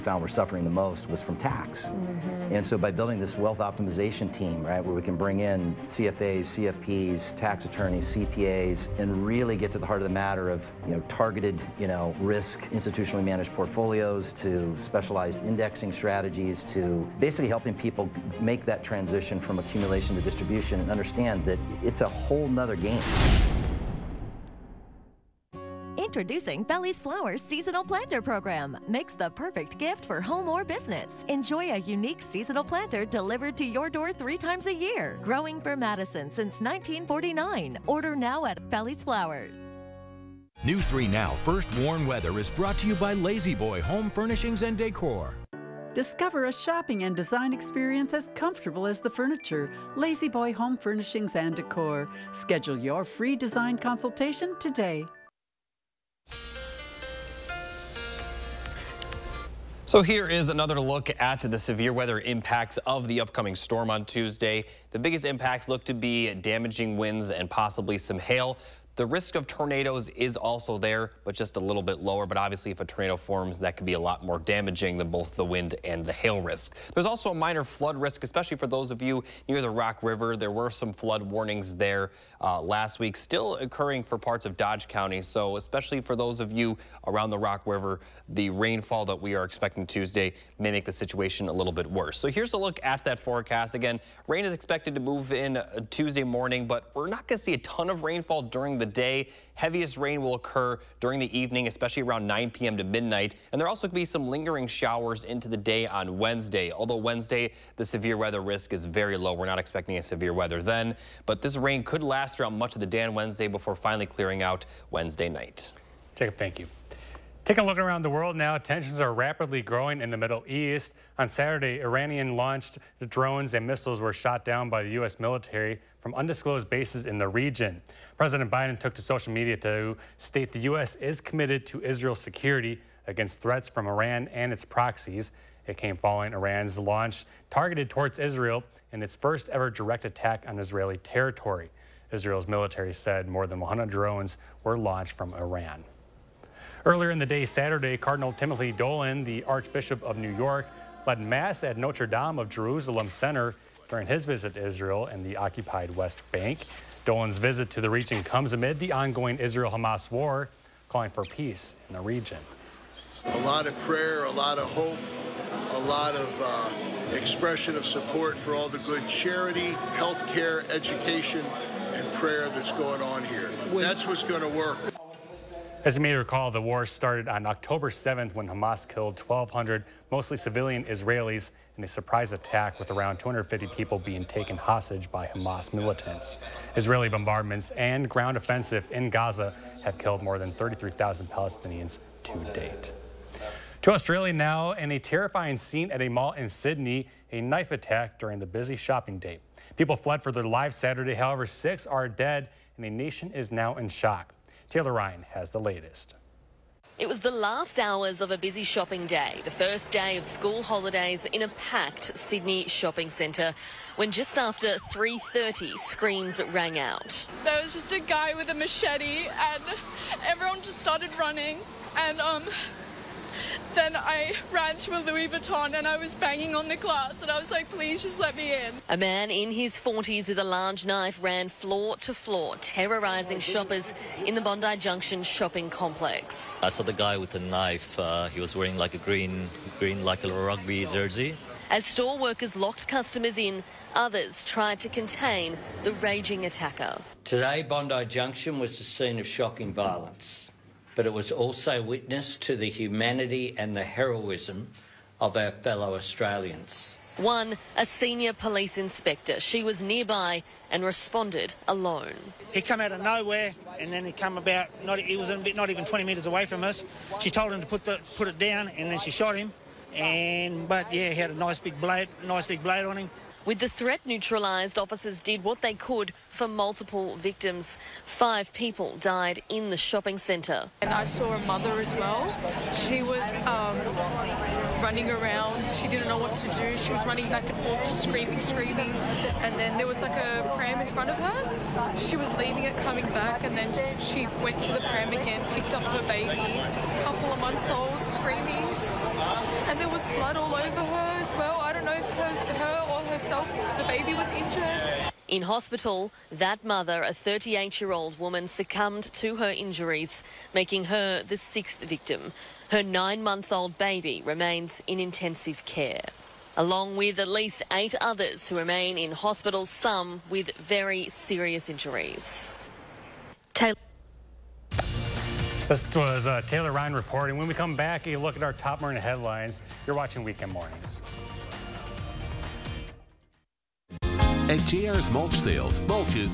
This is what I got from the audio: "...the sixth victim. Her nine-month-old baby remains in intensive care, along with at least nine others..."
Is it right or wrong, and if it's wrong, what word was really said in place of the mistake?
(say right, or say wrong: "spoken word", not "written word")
wrong: "eight", not "nine".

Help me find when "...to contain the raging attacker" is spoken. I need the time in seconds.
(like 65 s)
244 s.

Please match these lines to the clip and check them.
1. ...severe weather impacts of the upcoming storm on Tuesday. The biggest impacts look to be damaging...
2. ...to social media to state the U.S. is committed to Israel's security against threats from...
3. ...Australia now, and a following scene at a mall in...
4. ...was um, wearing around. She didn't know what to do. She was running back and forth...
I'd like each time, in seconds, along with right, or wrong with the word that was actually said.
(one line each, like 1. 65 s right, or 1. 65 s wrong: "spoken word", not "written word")
1. 61 s right
2. 128 s right
3. 193 s wrong: "terrifying", not "following"
4. 283 s wrong: "running", not "wearing".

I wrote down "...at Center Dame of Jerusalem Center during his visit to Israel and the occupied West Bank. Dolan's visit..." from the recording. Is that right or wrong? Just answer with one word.
wrong.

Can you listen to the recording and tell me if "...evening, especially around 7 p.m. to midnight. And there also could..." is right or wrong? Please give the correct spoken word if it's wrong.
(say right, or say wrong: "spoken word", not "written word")
wrong: "9", not "7".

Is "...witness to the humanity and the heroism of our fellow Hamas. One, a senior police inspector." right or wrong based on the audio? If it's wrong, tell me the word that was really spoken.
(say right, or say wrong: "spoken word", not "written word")
wrong: "Australians", not "Hamas".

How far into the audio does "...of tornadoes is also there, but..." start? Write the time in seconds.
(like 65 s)
69 s.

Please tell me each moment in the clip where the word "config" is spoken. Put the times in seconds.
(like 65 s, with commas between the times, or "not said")
not said.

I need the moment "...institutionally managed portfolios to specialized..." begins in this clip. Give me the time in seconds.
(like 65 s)
12 s.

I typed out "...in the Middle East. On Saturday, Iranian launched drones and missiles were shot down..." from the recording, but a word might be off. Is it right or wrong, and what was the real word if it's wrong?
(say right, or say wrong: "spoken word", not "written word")
right.